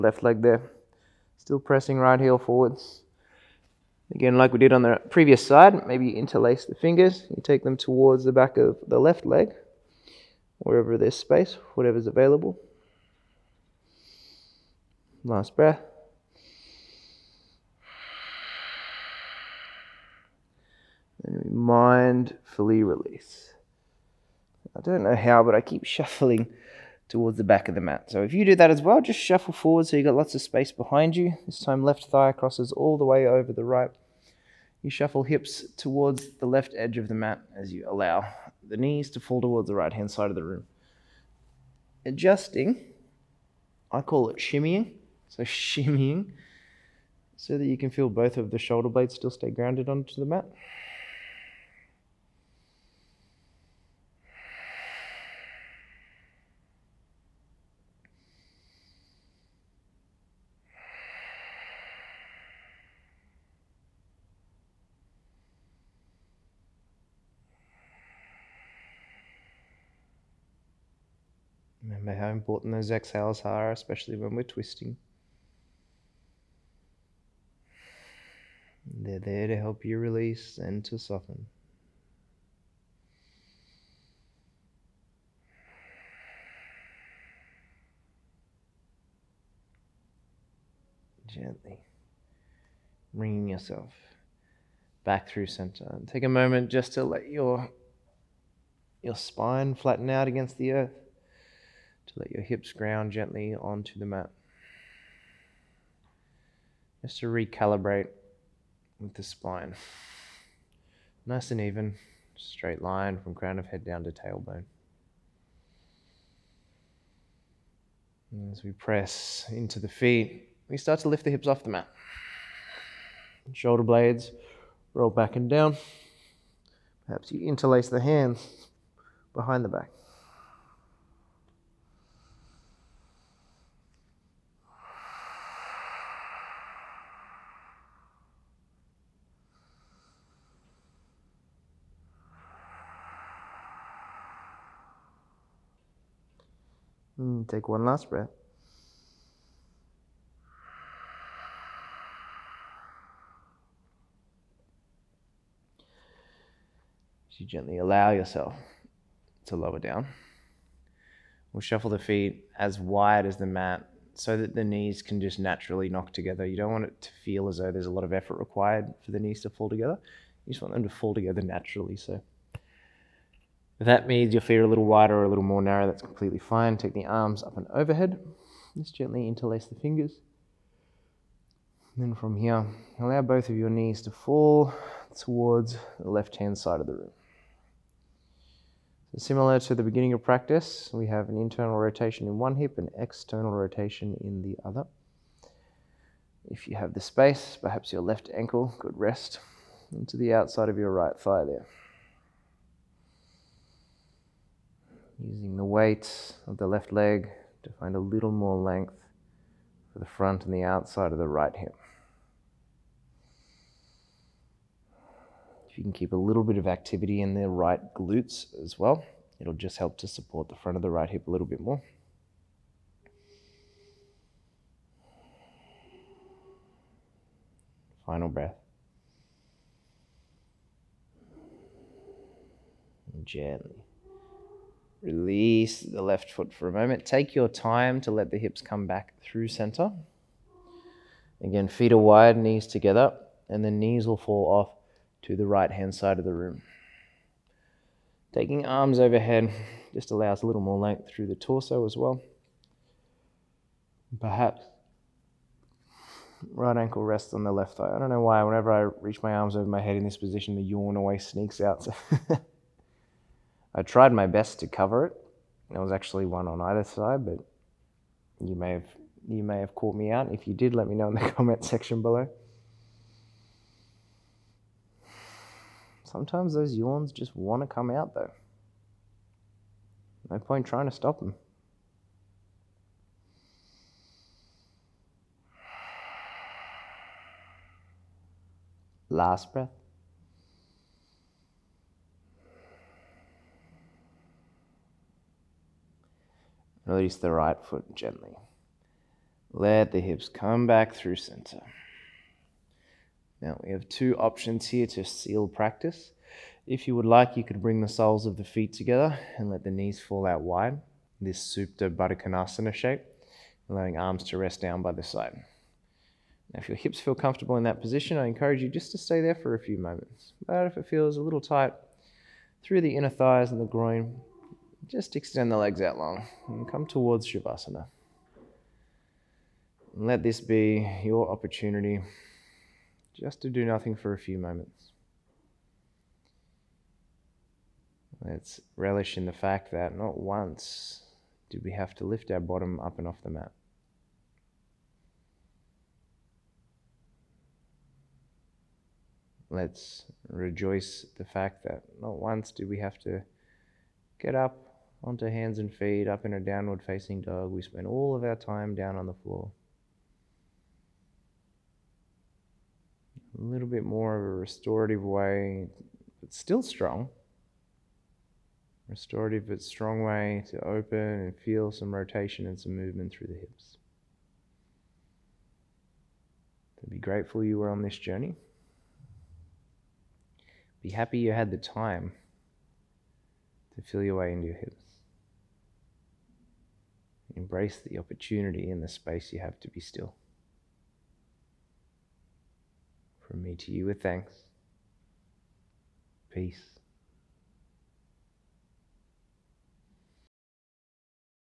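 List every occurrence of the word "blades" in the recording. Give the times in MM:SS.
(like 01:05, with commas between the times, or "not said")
00:48, 02:03.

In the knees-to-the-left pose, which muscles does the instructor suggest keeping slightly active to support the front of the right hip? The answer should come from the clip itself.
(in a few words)
Right glutes.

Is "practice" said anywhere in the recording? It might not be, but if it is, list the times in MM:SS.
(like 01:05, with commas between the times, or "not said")
03:10, 05:05.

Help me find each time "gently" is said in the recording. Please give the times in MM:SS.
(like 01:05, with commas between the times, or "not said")
01:31, 01:43, 02:37, 02:58, 03:53, 04:57.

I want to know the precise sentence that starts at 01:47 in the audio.
Just to recalibrate with the spine.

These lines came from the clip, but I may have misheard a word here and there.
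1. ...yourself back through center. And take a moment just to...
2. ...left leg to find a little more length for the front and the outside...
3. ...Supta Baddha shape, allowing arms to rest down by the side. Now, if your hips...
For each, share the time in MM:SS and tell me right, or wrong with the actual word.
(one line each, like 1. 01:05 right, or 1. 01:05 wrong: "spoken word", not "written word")
1. 01:33 right
2. 03:26 right
3. 05:11 right.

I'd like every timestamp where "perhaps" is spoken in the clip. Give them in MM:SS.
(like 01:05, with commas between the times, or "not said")
02:07, 03:17, 04:14.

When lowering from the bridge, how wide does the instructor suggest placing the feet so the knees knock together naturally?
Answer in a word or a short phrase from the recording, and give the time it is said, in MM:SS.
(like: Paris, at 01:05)
As wide as the mat, at 02:42.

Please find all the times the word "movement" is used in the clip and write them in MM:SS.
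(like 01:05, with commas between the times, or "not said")
06:12.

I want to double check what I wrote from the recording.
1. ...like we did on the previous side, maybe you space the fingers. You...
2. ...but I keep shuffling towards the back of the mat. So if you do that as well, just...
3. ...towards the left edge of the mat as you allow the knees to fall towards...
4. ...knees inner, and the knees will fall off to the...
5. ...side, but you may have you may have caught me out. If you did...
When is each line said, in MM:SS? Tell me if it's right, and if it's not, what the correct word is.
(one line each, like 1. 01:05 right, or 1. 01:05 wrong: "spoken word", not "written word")
1. 00:04 wrong: "interlace", not "space"
2. 00:25 right
3. 00:35 right
4. 04:02 wrong: "together", not "inner"
5. 04:26 right.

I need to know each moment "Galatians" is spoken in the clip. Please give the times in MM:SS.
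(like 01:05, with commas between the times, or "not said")
not said.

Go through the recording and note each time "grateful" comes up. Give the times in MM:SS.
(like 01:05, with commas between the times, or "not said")
06:16.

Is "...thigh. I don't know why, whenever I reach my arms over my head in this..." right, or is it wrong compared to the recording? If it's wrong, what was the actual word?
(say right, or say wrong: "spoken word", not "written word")
right.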